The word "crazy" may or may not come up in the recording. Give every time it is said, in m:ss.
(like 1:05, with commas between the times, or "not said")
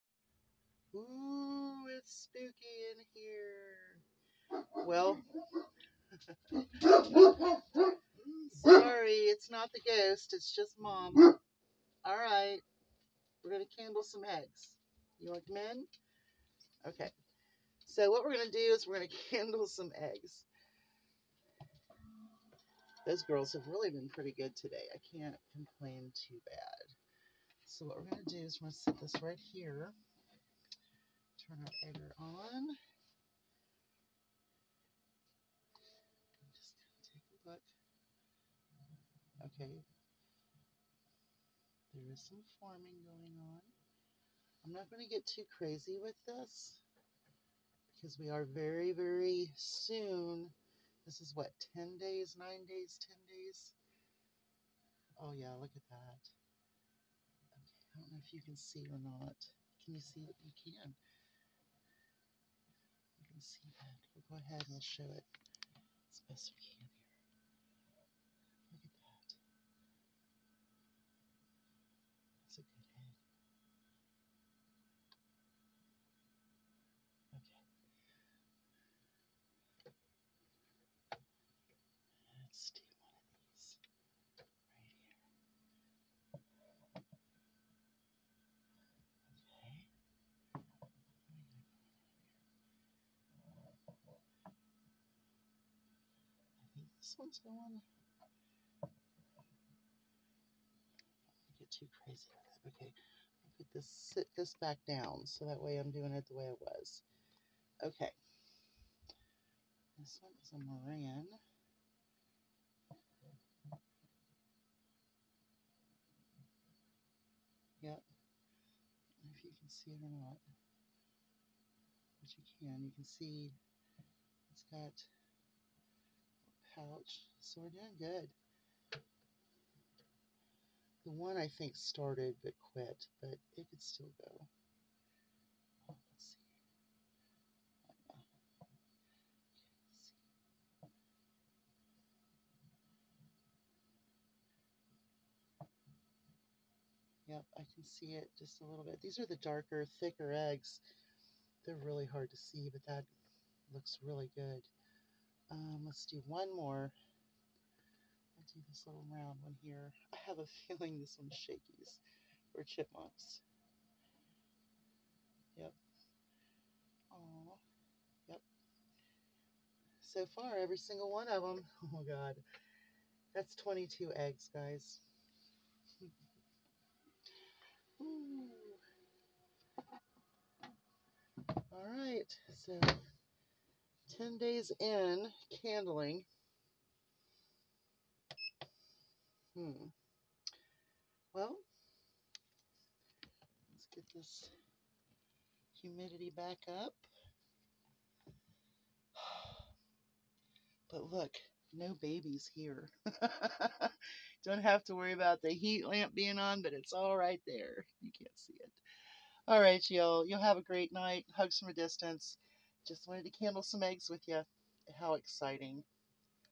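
0:45, 1:42.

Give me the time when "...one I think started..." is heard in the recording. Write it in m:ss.
2:11.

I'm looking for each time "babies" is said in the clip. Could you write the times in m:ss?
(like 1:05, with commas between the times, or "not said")
3:22.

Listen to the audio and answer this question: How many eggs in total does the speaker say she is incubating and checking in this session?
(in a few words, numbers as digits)
22.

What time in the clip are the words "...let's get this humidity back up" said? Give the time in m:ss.
3:13.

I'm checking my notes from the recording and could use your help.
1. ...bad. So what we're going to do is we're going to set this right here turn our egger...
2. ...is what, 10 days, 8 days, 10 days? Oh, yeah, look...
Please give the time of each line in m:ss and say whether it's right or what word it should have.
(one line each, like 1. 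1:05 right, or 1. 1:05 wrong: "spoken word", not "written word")
1. 0:26 right
2. 0:51 wrong: "9", not "8".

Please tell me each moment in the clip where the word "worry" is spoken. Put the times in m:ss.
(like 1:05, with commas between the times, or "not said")
3:24.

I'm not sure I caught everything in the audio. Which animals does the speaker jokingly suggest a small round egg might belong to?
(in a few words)
chipmunks.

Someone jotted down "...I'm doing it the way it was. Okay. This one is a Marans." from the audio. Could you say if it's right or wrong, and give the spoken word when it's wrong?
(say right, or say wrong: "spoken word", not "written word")
right.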